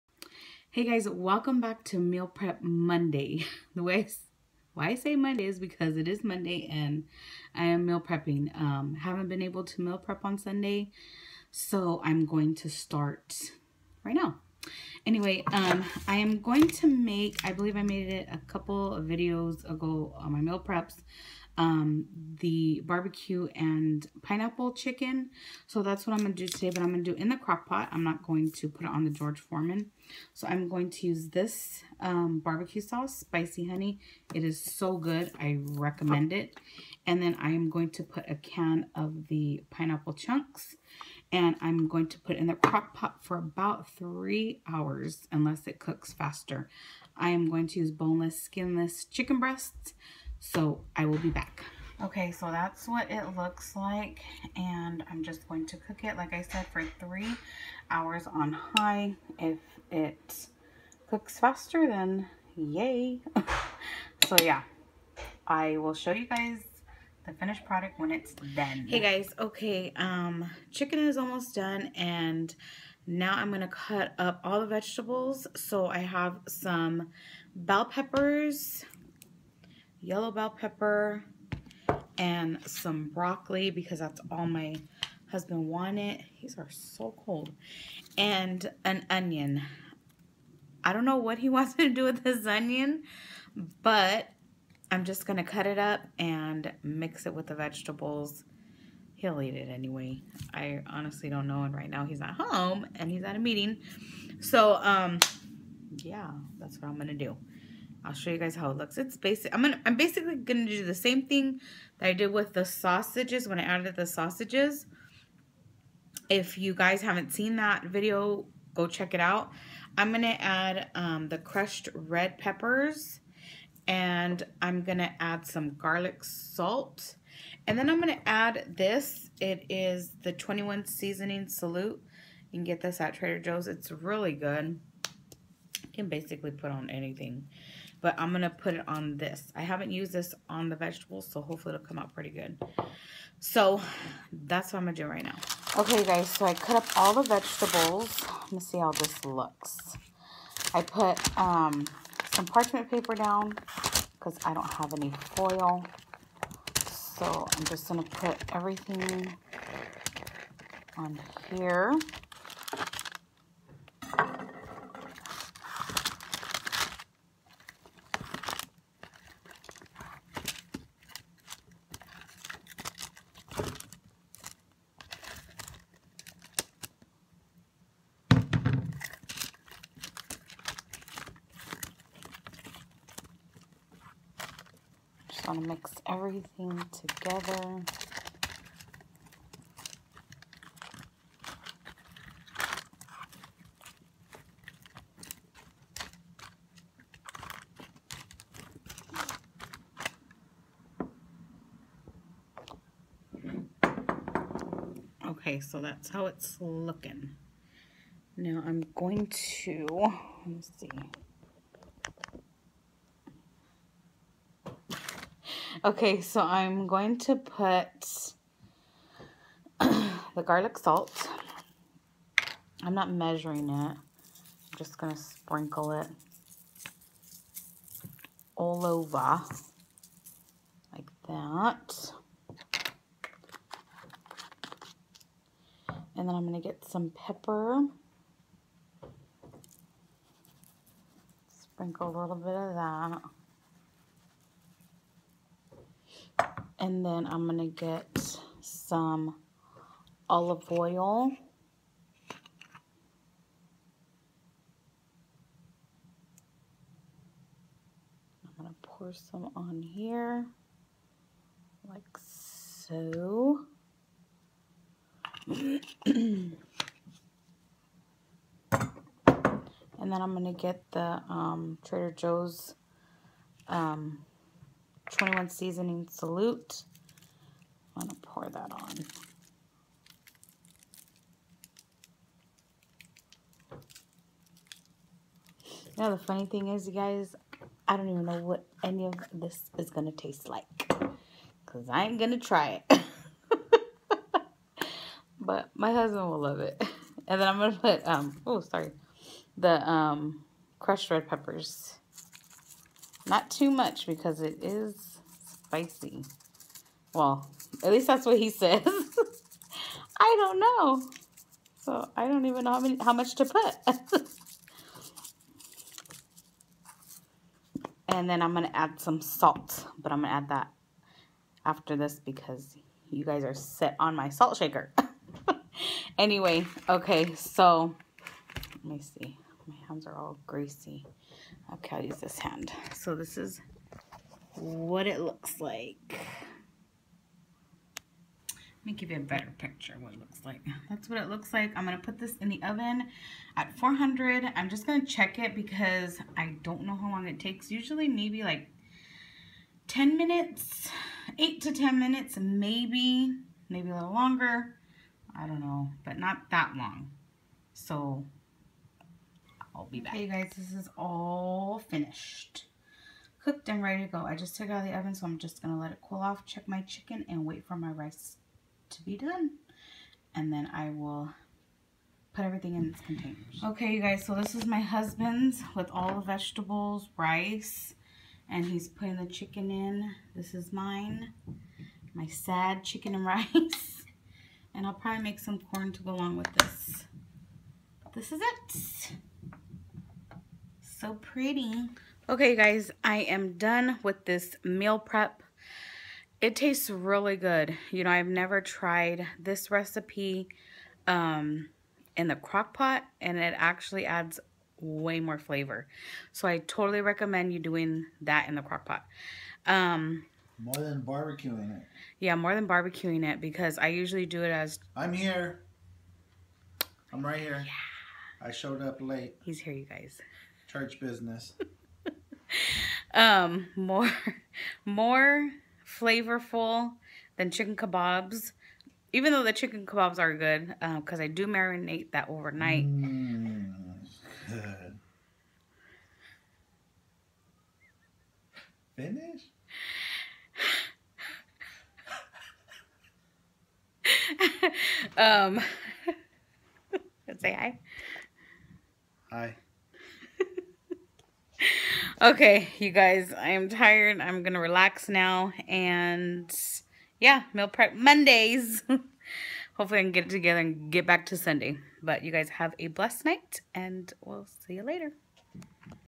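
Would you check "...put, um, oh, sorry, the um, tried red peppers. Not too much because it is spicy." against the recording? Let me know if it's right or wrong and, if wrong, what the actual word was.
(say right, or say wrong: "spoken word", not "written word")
wrong: "crushed", not "tried".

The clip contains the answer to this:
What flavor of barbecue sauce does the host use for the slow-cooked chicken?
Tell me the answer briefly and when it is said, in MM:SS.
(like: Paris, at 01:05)
spicy honey, at 00:33.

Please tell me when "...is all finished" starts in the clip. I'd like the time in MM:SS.
06:00.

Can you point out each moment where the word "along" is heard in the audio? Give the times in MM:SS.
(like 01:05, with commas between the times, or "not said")
06:26.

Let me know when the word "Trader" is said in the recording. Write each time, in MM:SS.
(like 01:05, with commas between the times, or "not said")
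02:13, 04:31.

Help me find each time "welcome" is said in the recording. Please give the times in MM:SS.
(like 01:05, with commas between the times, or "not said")
00:01.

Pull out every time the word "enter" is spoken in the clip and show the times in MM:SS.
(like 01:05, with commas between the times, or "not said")
not said.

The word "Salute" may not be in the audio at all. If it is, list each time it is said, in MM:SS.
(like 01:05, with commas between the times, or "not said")
02:11, 04:36.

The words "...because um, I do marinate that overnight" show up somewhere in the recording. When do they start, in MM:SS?
07:10.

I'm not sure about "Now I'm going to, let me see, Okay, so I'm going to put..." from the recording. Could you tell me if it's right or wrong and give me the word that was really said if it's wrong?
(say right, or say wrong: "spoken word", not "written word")
right.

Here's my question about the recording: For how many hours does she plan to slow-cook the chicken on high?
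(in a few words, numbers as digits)
3.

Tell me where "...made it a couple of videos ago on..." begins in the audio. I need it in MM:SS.
00:17.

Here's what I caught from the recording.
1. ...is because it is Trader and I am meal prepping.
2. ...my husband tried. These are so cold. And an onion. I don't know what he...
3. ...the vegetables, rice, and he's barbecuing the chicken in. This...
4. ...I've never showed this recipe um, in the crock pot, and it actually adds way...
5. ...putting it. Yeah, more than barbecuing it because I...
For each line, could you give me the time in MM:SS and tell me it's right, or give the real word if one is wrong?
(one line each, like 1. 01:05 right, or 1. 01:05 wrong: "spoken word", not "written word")
1. 00:05 wrong: "Monday", not "Trader"
2. 01:24 wrong: "wanted", not "tried"
3. 06:16 wrong: "putting", not "barbecuing"
4. 06:38 wrong: "tried", not "showed"
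5. 06:51 wrong: "barbecuing", not "putting".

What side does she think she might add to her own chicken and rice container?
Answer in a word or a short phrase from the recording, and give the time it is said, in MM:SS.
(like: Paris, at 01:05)
corn, at 06:25.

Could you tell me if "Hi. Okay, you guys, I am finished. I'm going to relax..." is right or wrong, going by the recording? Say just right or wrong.
wrong.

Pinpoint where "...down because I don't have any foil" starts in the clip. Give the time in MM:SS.
02:33.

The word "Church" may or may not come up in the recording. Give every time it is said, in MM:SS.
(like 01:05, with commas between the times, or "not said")
07:00.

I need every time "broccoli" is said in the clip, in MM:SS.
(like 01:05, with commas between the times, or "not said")
01:23.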